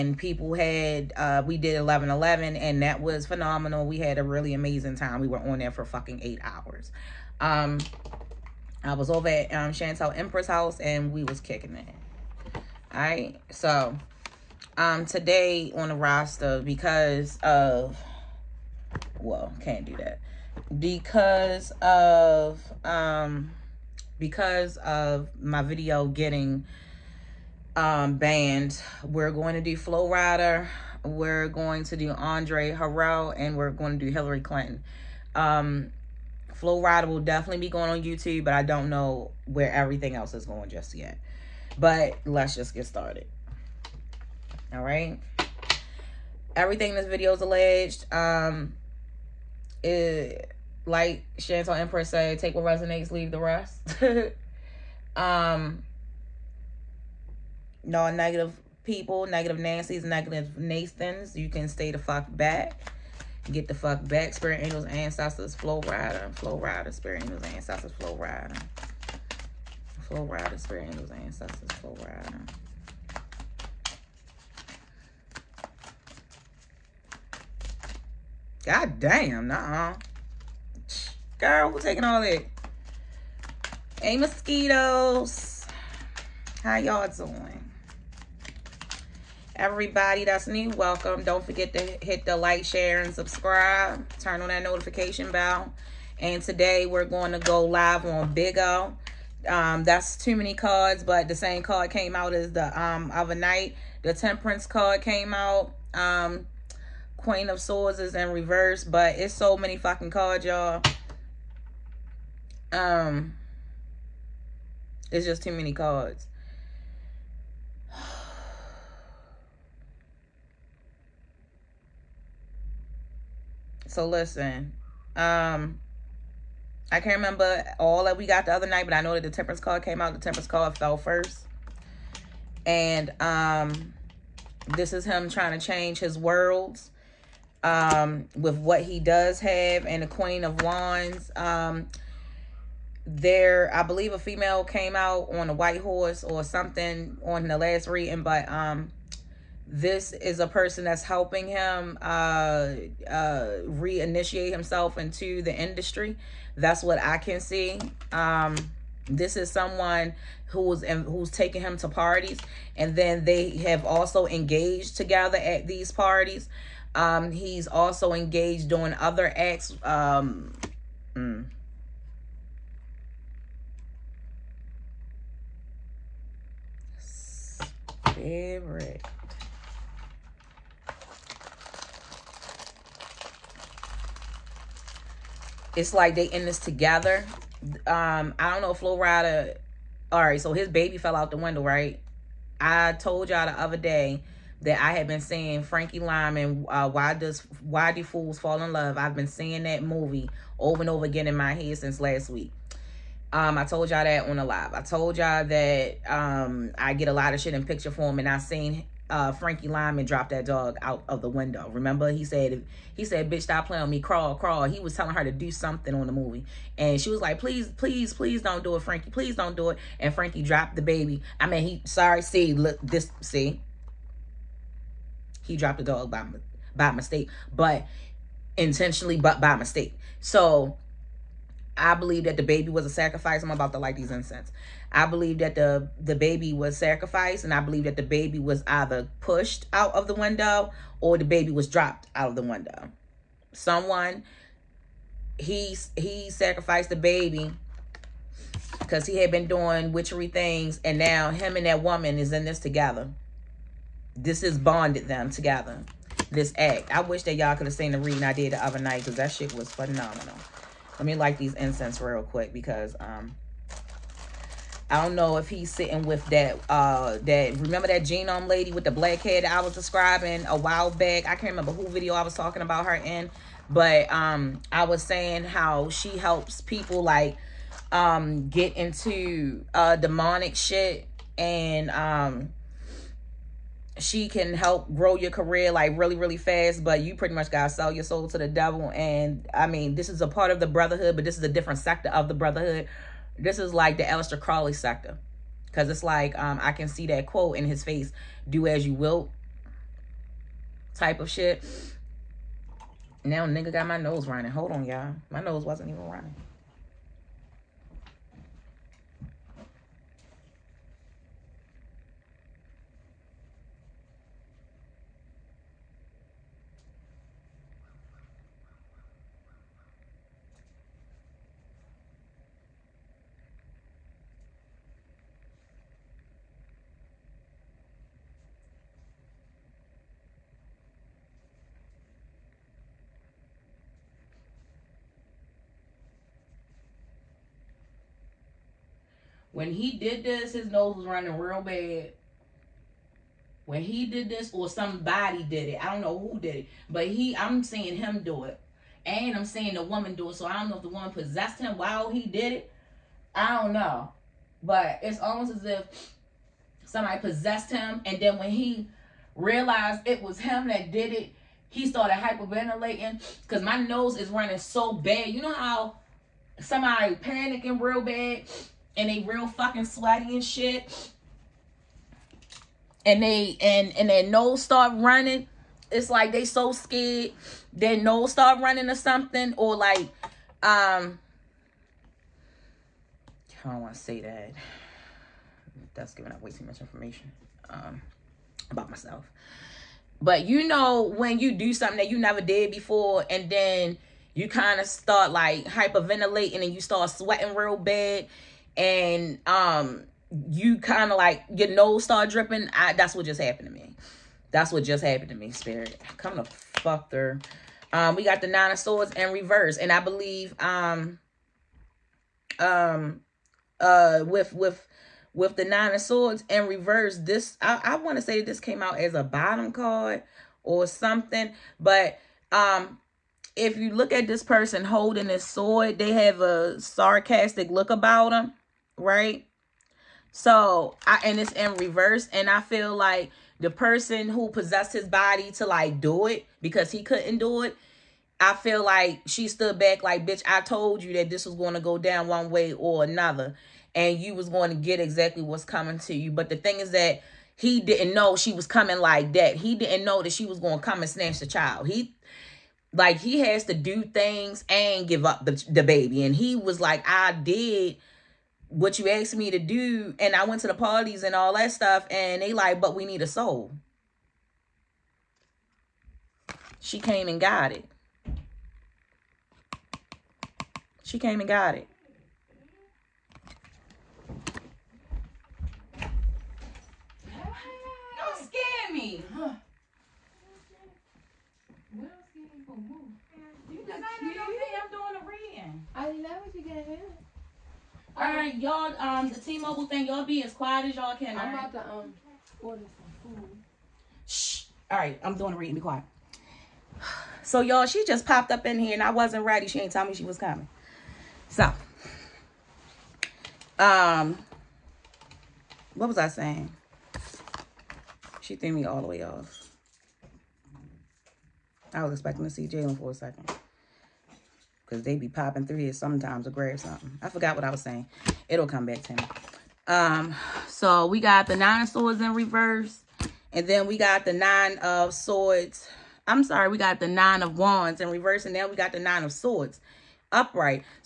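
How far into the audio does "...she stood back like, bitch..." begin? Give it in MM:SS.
07:19.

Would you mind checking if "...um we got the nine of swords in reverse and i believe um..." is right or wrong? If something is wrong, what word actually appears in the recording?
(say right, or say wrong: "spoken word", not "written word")
right.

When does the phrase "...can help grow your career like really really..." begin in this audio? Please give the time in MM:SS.
04:44.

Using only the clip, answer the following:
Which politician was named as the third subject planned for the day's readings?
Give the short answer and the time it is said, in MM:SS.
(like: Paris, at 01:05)
Hillary Clinton, at 00:34.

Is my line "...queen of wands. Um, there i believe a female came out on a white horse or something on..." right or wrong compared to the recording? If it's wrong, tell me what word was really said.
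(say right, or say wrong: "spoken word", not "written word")
right.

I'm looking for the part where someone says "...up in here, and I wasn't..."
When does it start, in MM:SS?
08:18.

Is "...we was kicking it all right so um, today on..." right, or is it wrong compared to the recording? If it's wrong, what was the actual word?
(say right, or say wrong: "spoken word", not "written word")
right.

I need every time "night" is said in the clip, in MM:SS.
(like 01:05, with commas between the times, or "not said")
01:43, 02:08, 04:18.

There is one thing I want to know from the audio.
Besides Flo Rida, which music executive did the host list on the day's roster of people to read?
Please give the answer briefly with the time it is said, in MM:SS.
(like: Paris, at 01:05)
Andre Harrell, at 00:32.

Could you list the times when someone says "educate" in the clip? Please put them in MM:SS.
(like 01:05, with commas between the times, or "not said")
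not said.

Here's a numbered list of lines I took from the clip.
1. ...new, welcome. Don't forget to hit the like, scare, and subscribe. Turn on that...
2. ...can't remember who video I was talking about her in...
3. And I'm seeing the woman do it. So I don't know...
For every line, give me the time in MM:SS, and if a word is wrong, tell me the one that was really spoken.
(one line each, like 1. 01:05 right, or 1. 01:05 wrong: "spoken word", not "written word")
1. 01:30 wrong: "share", not "scare"
2. 04:31 right
3. 05:49 right.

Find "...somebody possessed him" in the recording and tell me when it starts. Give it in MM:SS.
05:56.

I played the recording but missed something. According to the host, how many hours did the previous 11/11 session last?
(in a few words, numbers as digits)
8.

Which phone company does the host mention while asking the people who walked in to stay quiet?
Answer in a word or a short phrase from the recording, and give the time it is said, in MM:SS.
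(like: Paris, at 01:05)
T-Mobile, at 08:09.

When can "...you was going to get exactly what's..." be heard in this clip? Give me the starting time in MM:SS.
07:24.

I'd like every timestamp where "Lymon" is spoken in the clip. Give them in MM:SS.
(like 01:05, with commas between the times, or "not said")
03:15, 03:29.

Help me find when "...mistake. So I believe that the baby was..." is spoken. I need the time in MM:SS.
03:49.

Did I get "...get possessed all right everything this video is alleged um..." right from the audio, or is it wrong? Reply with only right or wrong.
wrong.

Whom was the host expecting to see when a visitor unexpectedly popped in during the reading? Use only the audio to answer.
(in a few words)
Jalen.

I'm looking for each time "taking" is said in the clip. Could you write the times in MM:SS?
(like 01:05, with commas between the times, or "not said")
01:21, 02:41.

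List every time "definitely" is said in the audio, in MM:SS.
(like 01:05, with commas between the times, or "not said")
00:37.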